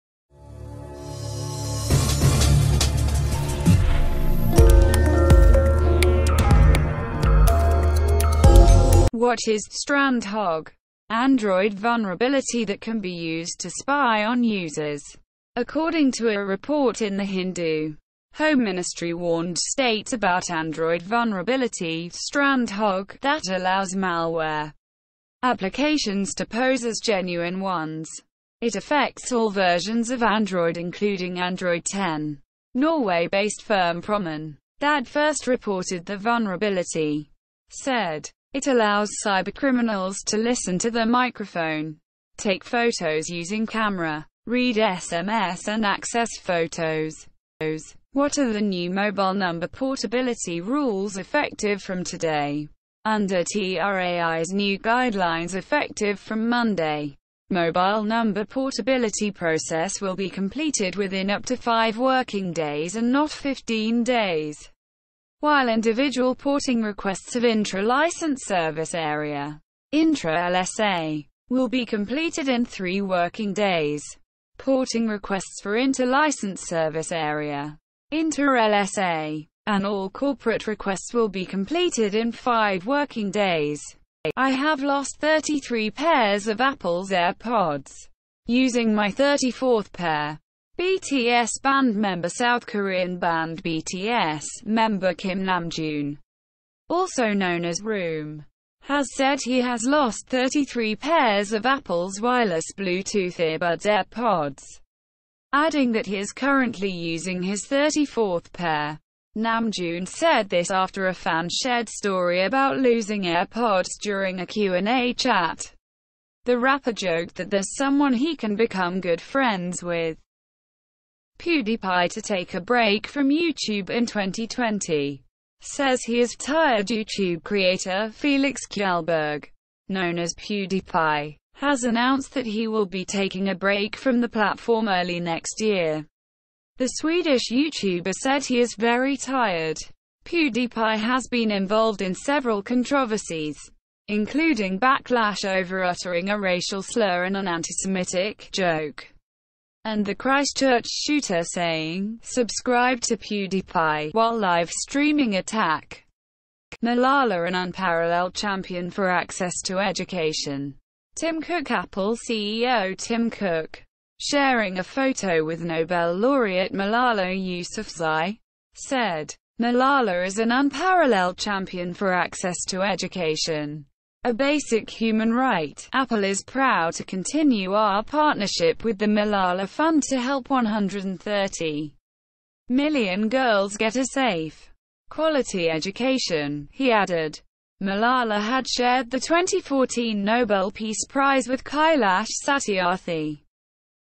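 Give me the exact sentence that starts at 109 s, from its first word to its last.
Namjoon said this after a fan shared story about losing AirPods during a Q&A chat.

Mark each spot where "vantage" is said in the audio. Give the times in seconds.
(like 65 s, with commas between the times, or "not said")
not said.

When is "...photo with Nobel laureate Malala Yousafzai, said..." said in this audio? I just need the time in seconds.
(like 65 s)
164 s.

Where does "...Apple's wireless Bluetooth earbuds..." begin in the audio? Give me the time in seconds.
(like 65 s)
101 s.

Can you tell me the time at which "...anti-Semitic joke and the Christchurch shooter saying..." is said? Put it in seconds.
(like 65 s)
147 s.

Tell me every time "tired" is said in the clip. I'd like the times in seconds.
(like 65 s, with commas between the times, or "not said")
126 s, 139 s.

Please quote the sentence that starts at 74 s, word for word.
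Porting requests for inter-license service area inter-LSA and all corporate requests will be completed in five working days.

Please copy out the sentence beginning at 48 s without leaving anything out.
What are the new mobile number portability rules effective from today?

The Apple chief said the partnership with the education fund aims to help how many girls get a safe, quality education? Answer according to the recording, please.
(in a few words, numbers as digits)
130 million.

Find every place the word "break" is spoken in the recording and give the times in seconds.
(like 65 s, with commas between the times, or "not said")
122 s, 133 s.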